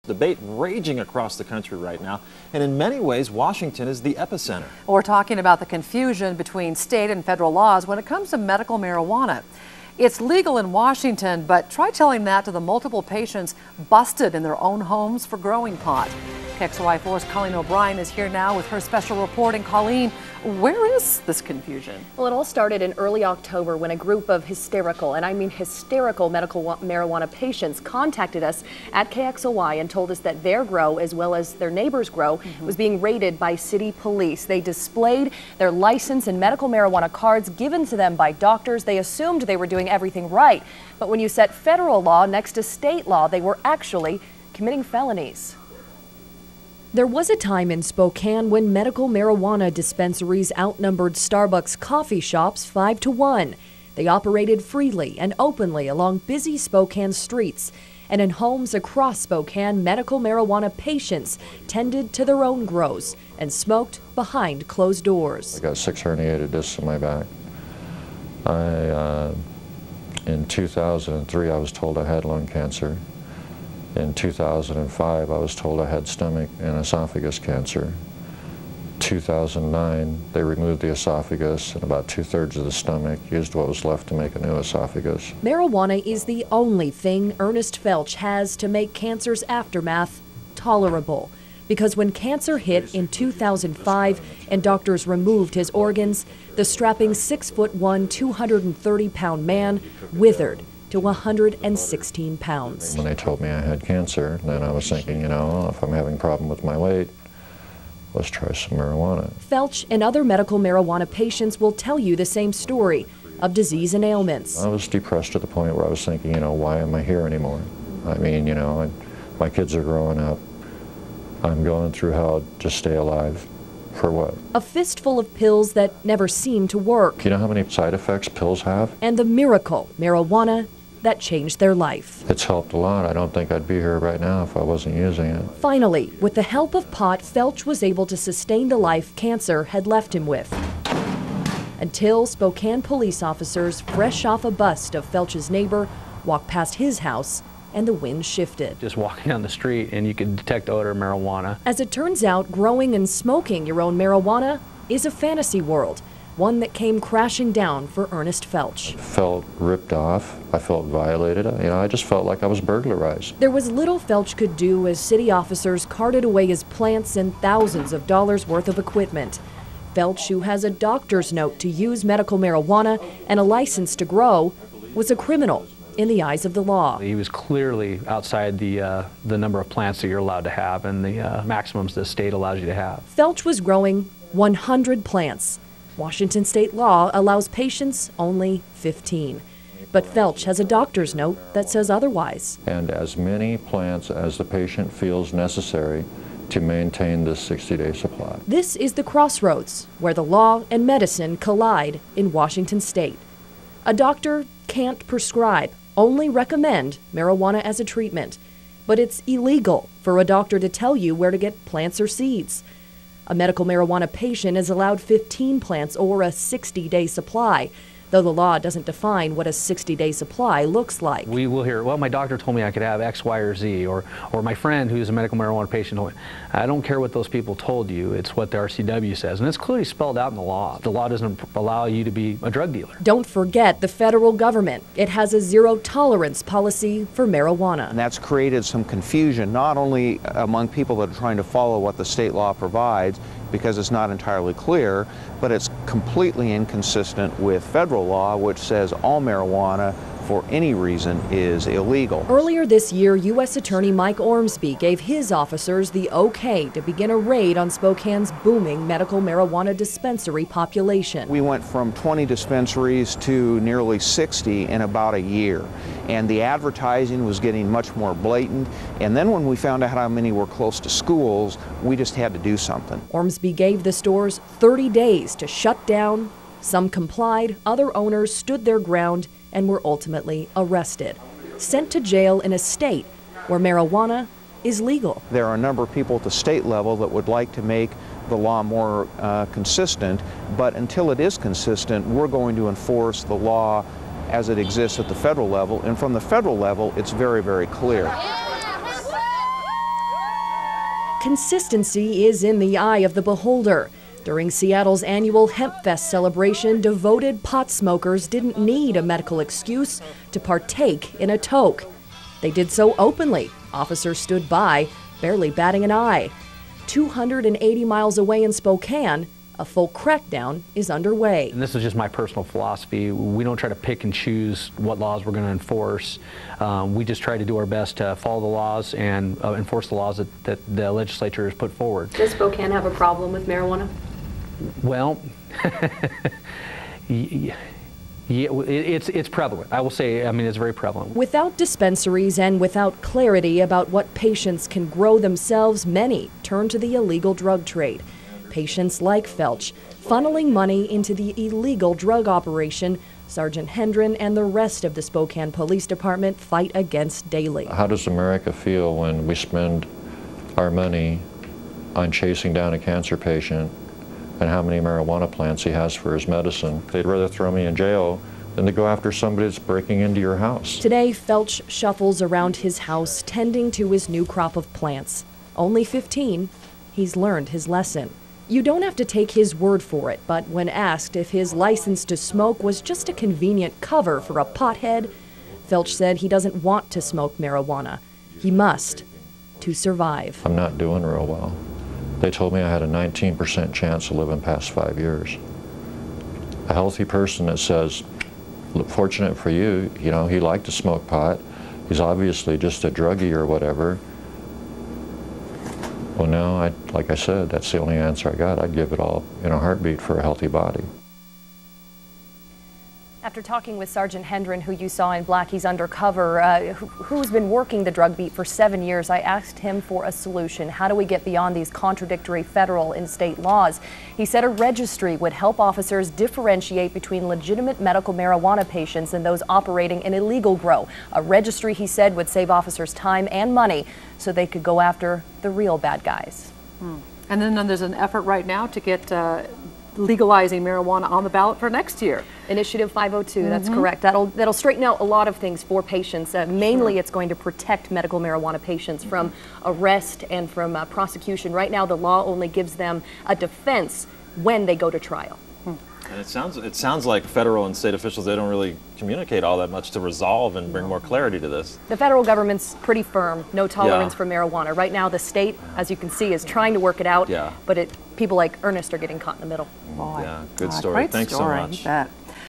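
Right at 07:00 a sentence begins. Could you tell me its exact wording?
How do we get beyond these contradictory federal and state laws?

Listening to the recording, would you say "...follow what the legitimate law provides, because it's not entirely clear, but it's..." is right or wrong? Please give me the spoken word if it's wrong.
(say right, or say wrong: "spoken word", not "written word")
wrong: "state", not "legitimate".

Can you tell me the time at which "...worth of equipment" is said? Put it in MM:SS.
02:48.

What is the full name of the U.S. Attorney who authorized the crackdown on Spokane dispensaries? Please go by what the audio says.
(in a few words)
Mike Ormsby.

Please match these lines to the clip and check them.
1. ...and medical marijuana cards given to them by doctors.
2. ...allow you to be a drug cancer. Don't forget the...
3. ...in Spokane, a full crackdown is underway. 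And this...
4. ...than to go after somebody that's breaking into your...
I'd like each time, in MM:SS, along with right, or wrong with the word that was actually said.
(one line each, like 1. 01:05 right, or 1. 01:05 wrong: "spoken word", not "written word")
1. 00:36 right
2. 03:51 wrong: "dealer", not "cancer"
3. 05:18 right
4. 06:08 right.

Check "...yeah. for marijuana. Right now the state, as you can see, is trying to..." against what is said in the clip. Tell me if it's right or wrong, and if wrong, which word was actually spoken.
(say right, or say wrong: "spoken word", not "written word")
right.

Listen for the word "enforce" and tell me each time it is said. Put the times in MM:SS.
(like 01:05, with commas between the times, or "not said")
04:52, 05:25, 05:29.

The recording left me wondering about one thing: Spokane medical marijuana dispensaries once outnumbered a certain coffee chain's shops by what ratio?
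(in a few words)
5 to 1.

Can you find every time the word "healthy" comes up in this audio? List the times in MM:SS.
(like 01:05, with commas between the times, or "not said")
06:36, 06:50.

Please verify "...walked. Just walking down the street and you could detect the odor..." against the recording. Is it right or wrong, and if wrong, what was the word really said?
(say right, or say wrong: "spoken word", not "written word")
wrong: "shifted", not "walked".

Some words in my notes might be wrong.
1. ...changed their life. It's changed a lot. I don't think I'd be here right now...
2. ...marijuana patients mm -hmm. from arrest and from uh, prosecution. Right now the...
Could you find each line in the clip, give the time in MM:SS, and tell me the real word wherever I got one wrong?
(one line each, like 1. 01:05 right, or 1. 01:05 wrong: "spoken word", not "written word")
1. 02:11 wrong: "helped", not "changed"
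2. 07:28 right.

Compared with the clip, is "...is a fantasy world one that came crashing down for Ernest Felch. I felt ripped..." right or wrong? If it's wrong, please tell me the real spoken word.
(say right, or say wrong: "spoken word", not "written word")
right.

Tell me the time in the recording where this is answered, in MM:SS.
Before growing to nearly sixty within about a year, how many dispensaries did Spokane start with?
04:21.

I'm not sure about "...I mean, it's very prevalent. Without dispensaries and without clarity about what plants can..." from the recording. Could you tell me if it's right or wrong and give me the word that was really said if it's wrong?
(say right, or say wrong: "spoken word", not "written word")
wrong: "patients", not "plants".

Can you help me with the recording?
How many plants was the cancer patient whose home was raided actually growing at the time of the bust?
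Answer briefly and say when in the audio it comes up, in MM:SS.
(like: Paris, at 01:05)
100, at 03:04.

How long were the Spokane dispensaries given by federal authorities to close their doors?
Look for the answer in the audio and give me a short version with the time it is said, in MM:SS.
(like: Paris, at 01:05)
30 days, at 04:34.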